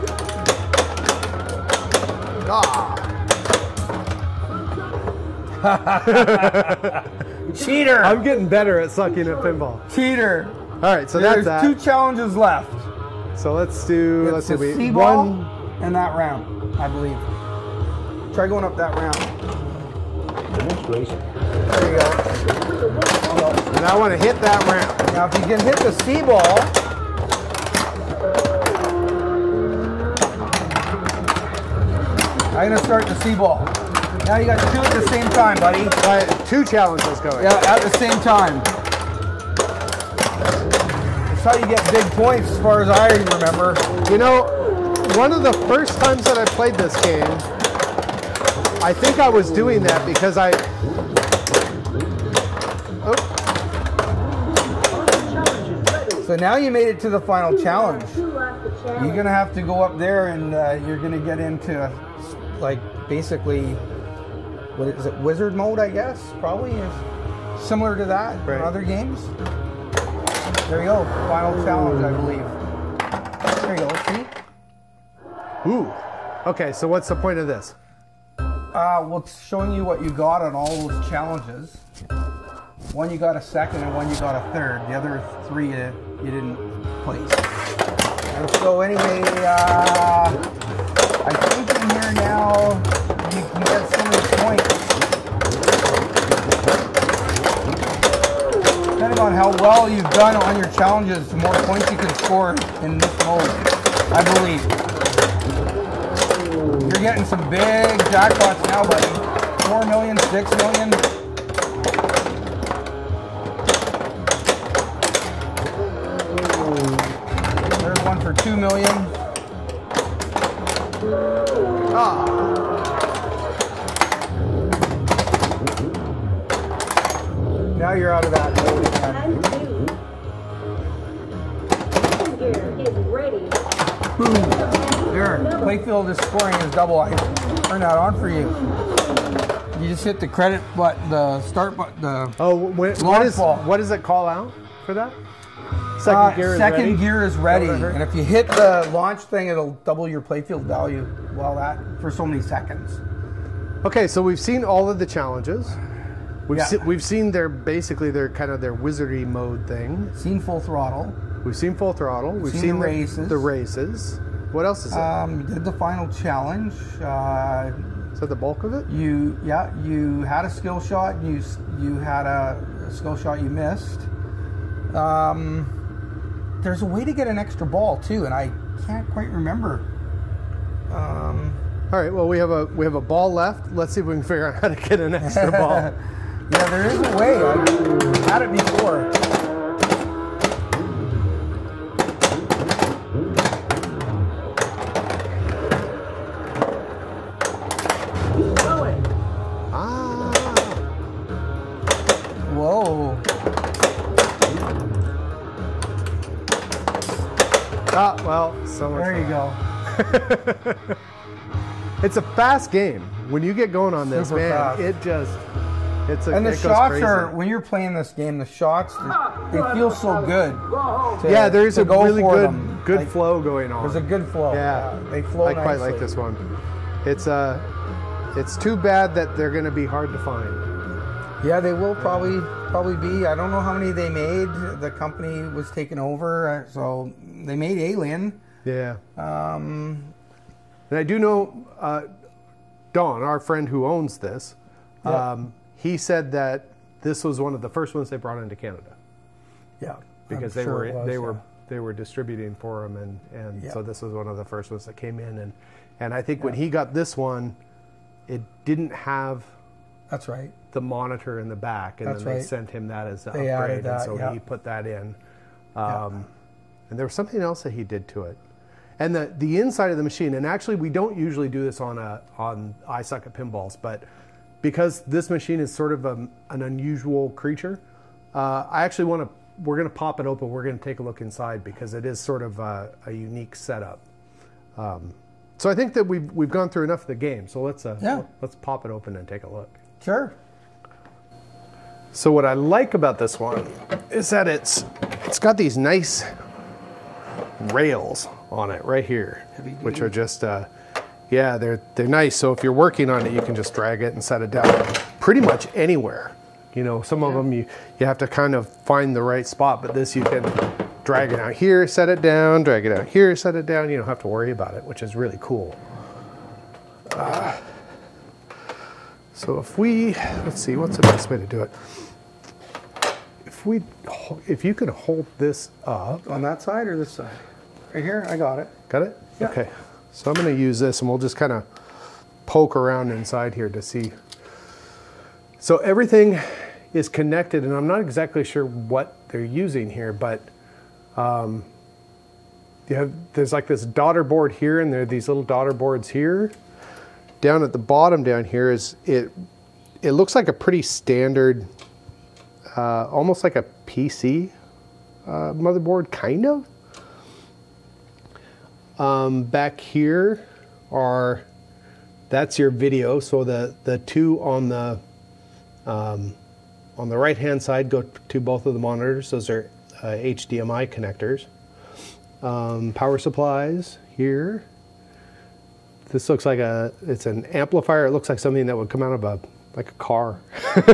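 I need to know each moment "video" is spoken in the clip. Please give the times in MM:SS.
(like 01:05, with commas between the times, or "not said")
06:02.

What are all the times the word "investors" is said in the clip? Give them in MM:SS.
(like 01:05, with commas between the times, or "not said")
not said.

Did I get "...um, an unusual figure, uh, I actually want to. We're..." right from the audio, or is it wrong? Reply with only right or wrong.
wrong.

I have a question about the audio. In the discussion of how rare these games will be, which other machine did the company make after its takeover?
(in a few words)
Alien.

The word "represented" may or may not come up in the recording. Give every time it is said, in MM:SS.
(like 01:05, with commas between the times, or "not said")
not said.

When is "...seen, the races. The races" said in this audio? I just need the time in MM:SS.
02:42.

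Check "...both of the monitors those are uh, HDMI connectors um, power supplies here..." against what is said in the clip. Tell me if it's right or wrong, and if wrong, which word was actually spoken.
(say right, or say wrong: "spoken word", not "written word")
right.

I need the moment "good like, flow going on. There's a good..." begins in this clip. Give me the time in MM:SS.
03:42.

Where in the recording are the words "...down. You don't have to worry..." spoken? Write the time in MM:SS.
05:13.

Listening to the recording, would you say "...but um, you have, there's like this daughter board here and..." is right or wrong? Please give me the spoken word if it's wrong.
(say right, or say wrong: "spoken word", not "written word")
right.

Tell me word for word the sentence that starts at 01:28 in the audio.
And so anyway, uh, I think in here now he gets so many points.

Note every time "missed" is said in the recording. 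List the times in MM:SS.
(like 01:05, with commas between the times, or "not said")
02:53.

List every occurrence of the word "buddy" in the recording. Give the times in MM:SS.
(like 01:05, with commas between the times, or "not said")
00:35, 01:48.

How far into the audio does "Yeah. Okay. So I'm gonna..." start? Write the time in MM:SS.
05:29.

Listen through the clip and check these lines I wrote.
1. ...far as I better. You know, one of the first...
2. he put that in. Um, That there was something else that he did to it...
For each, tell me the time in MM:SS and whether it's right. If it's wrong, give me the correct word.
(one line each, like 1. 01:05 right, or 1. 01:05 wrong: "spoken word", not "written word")
1. 00:42 wrong: "remember", not "better"
2. 04:24 wrong: "And", not "That".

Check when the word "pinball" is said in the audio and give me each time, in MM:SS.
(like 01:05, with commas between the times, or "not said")
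00:09, 04:33.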